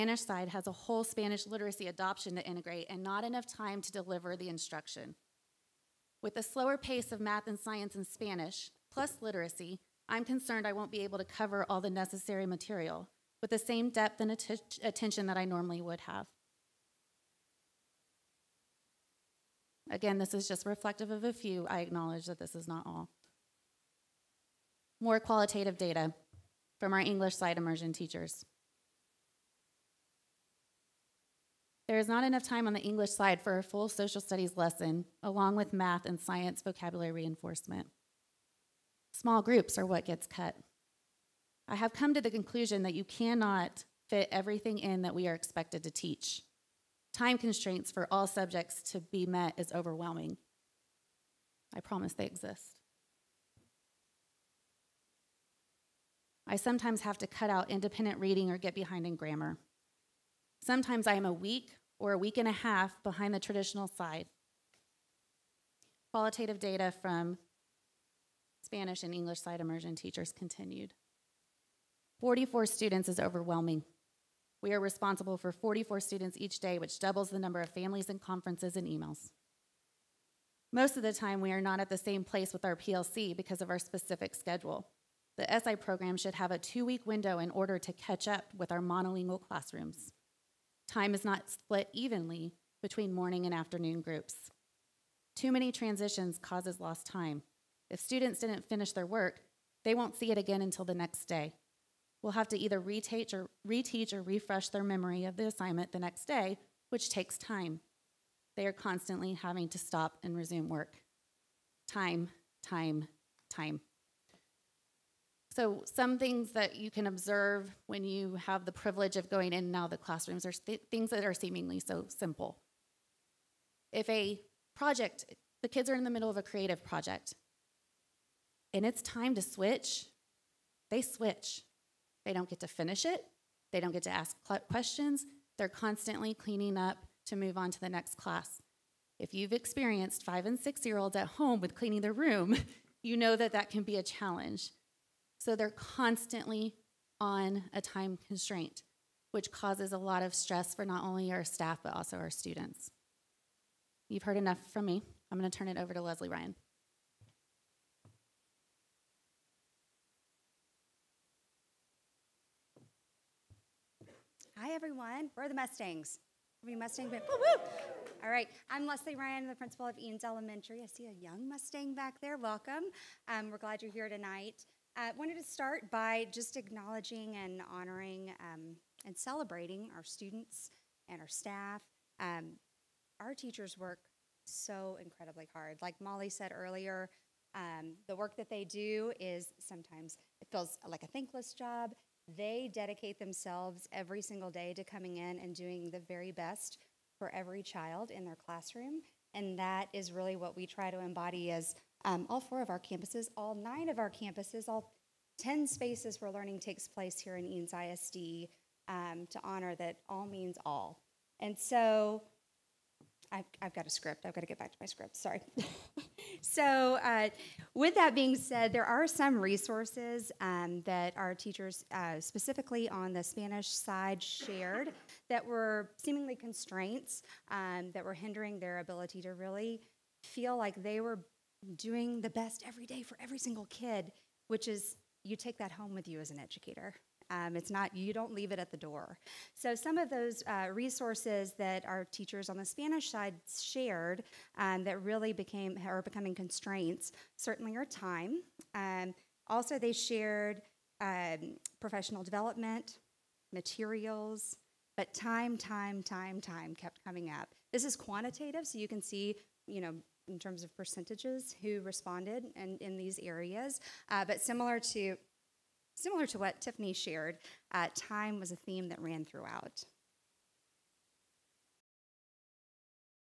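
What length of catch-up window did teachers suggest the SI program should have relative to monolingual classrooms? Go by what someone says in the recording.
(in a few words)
two week.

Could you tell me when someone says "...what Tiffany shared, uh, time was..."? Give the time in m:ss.
4:26.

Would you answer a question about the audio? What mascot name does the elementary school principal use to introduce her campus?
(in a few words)
Mustangs.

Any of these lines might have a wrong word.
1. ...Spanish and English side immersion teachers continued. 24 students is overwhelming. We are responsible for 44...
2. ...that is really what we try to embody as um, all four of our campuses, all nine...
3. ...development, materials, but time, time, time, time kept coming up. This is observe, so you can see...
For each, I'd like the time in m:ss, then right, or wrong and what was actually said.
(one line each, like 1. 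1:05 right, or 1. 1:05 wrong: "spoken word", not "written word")
1. 1:08 wrong: "44", not "24"
2. 3:19 right
3. 4:12 wrong: "quantitative", not "observe".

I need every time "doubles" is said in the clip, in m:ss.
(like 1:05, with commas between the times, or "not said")
1:16.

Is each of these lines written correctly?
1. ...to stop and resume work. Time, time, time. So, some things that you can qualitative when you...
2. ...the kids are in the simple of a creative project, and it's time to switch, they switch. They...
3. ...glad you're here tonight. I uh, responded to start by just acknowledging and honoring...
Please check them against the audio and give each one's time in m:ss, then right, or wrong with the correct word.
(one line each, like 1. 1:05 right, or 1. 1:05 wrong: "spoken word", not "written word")
1. 1:49 wrong: "observe", not "qualitative"
2. 2:05 wrong: "middle", not "simple"
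3. 2:53 wrong: "wanted", not "responded".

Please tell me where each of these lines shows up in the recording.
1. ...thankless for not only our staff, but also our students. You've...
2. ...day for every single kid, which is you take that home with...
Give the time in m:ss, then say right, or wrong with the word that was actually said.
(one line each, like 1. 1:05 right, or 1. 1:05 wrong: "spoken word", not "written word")
1. 2:30 wrong: "stress", not "thankless"
2. 3:52 right.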